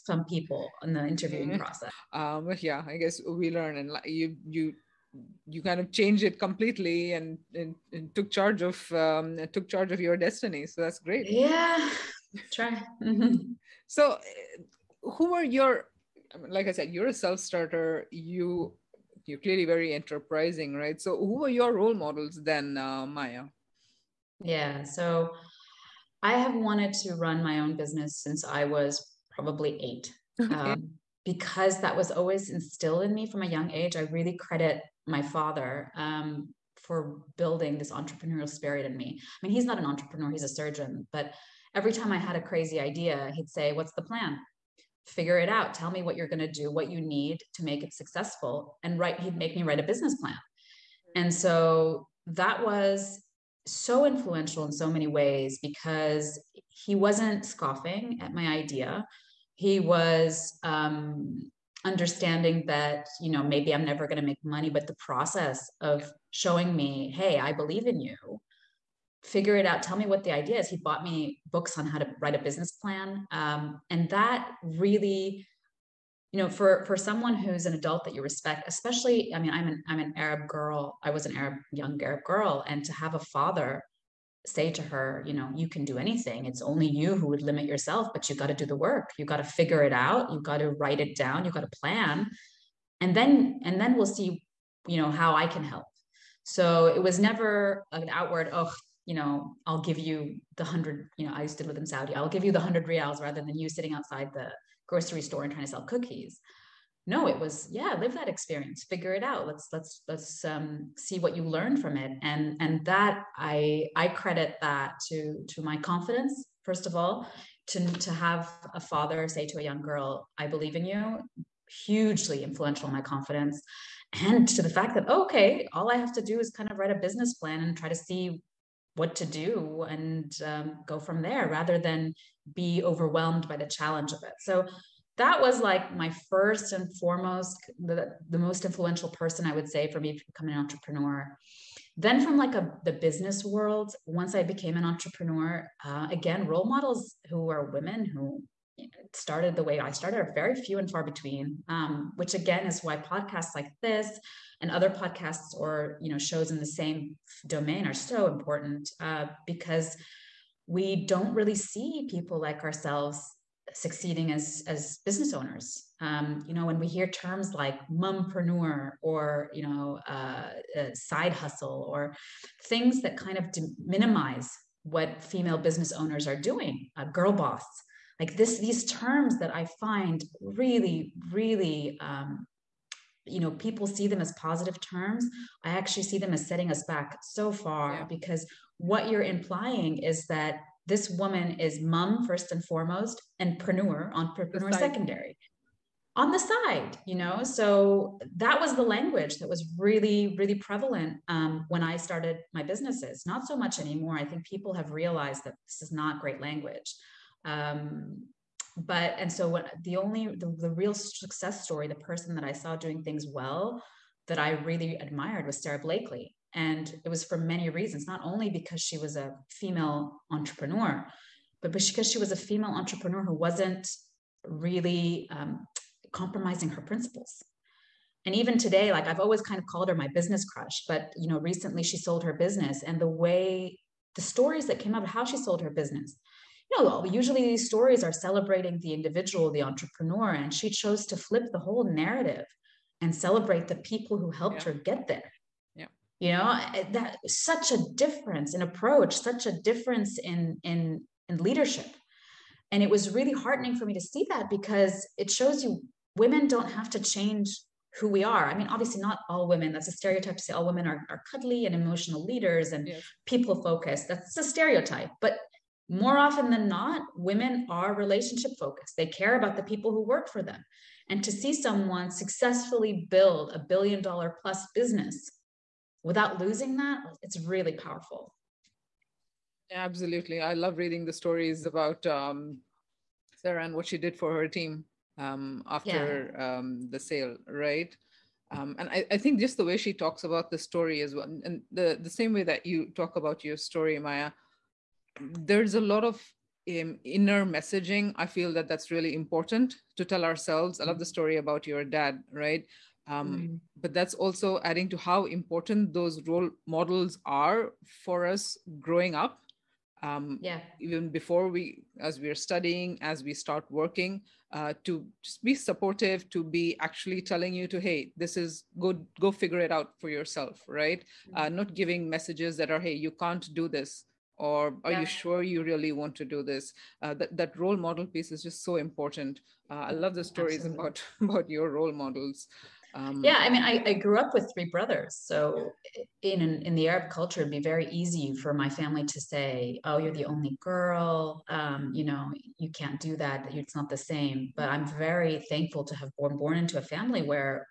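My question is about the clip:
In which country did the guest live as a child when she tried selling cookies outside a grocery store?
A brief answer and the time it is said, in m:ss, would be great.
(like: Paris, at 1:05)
Saudi, at 1:41.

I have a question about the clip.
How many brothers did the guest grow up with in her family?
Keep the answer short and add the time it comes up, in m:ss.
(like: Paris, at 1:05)
3, at 5:34.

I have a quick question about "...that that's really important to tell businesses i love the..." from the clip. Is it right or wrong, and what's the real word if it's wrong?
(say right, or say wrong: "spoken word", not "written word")
wrong: "ourselves", not "businesses".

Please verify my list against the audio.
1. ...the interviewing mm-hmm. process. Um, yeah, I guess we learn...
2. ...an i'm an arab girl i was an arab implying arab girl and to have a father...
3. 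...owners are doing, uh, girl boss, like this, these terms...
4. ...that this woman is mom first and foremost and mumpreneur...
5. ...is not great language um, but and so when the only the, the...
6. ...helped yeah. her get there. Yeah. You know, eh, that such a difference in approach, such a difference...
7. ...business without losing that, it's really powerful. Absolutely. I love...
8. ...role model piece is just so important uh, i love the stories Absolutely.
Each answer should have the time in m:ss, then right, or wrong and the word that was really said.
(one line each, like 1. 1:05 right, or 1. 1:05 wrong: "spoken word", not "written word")
1. 0:00 right
2. 1:19 wrong: "young", not "implying"
3. 2:55 right
4. 3:10 wrong: "preneur", not "mumpreneur"
5. 3:25 right
6. 4:04 right
7. 4:34 right
8. 5:27 right.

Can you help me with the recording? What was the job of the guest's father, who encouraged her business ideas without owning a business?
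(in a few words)
Surgeon.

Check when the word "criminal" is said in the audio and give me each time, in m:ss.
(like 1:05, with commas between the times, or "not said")
not said.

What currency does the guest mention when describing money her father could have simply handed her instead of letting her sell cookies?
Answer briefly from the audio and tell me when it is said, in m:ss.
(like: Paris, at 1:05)
Riyals, at 1:42.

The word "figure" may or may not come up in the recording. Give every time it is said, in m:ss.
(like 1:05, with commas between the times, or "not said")
0:45, 1:09, 1:29, 1:48, 5:19.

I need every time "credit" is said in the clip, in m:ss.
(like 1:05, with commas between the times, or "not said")
0:34, 1:54.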